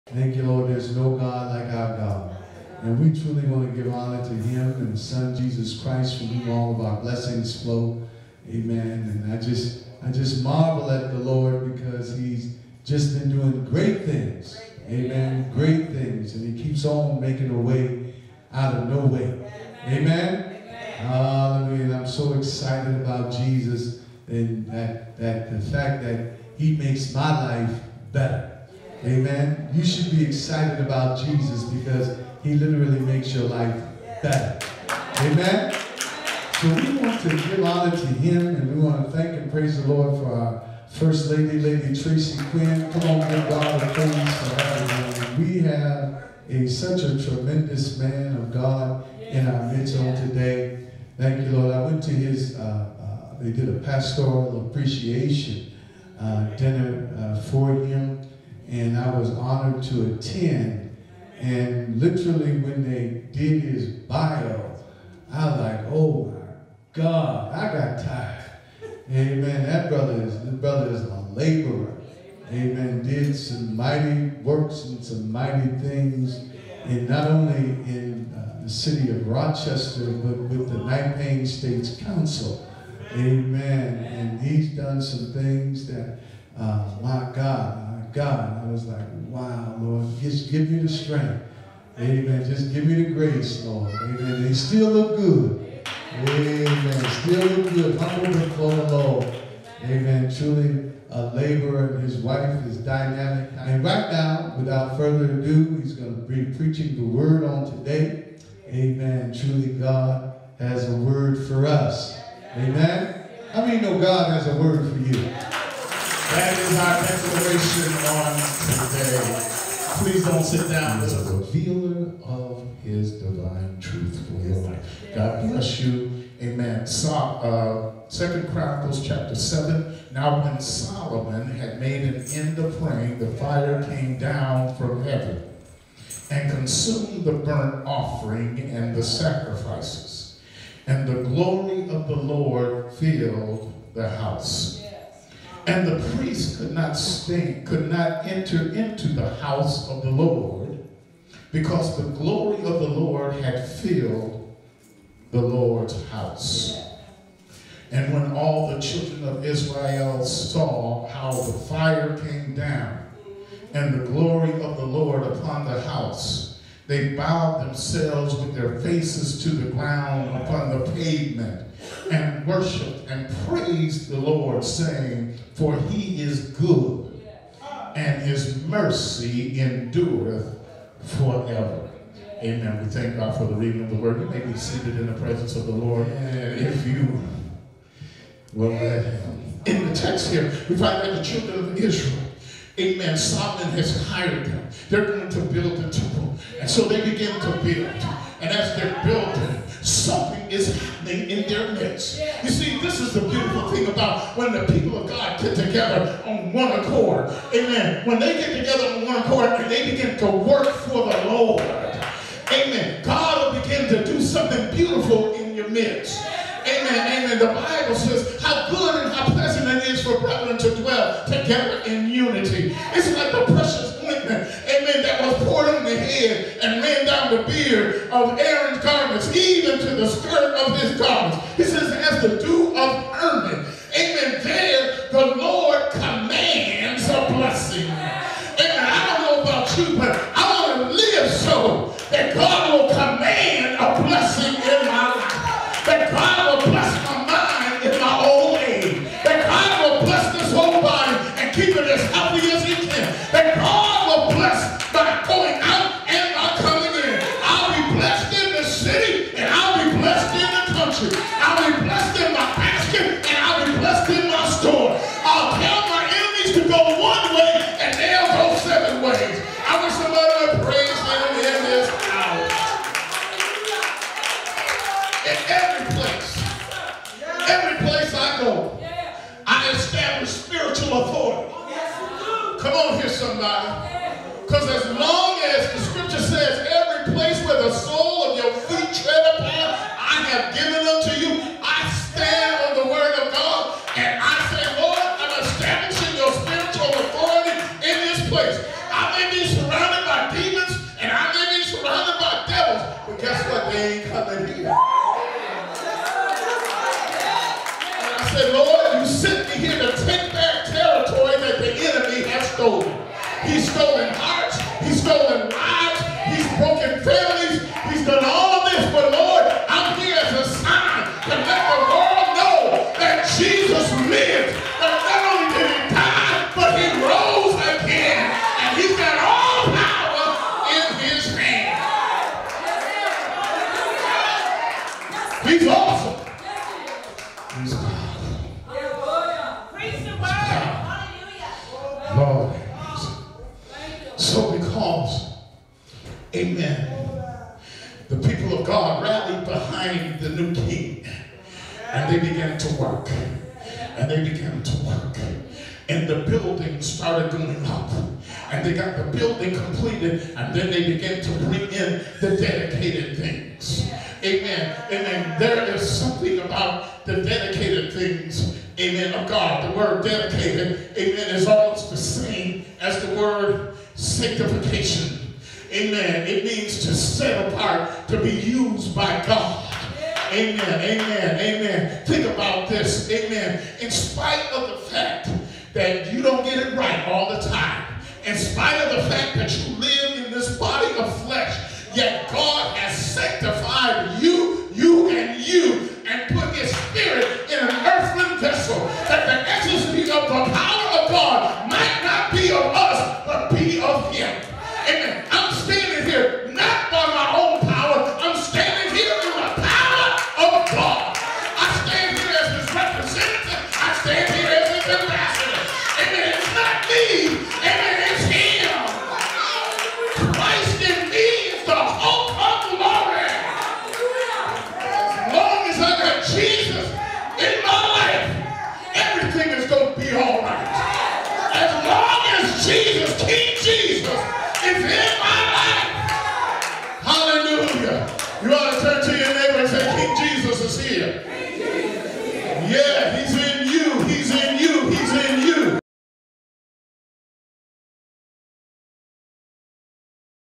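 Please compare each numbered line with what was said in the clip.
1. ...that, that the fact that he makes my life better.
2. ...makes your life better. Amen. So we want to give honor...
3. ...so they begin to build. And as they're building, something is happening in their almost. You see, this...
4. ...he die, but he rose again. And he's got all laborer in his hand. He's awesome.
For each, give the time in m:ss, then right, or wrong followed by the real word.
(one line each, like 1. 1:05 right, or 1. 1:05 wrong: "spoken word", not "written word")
1. 0:24 right
2. 0:32 right
3. 3:16 wrong: "midst", not "almost"
4. 5:25 wrong: "power", not "laborer".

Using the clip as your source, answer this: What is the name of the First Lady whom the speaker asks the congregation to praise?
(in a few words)
Lady Tracy Quinn.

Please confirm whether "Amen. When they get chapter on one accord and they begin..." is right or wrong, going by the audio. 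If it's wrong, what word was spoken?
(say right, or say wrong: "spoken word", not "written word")
wrong: "together", not "chapter".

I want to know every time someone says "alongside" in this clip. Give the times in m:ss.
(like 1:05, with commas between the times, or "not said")
not said.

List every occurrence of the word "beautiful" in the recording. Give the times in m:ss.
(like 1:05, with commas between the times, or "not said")
3:23, 3:34.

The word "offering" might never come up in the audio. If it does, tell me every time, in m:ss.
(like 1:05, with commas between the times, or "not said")
2:17.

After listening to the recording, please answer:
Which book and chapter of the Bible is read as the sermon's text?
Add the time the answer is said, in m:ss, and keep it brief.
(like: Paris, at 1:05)
Second Chronicles 7, at 2:08.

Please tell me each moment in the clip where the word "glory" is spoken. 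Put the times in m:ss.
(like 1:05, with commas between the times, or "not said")
2:21, 2:32, 2:44.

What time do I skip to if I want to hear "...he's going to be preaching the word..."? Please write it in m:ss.
1:45.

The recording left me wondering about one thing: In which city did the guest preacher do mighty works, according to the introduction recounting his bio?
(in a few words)
Rochester.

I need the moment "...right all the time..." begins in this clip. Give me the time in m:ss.
6:26.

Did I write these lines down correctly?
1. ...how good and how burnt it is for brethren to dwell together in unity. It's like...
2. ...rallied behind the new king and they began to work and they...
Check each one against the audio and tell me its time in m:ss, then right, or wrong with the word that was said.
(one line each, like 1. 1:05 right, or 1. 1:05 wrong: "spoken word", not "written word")
1. 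3:38 wrong: "pleasant", not "burnt"
2. 5:49 right.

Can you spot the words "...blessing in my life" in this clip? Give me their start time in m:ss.
4:04.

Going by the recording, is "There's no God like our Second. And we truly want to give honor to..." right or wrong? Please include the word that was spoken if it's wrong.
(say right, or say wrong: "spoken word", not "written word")
wrong: "God", not "Second".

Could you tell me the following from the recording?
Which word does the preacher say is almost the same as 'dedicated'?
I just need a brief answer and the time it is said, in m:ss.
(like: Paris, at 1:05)
sanctification, at 6:13.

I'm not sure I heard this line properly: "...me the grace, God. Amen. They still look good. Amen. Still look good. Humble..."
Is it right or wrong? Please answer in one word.
wrong.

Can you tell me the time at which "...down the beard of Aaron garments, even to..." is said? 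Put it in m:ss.
3:47.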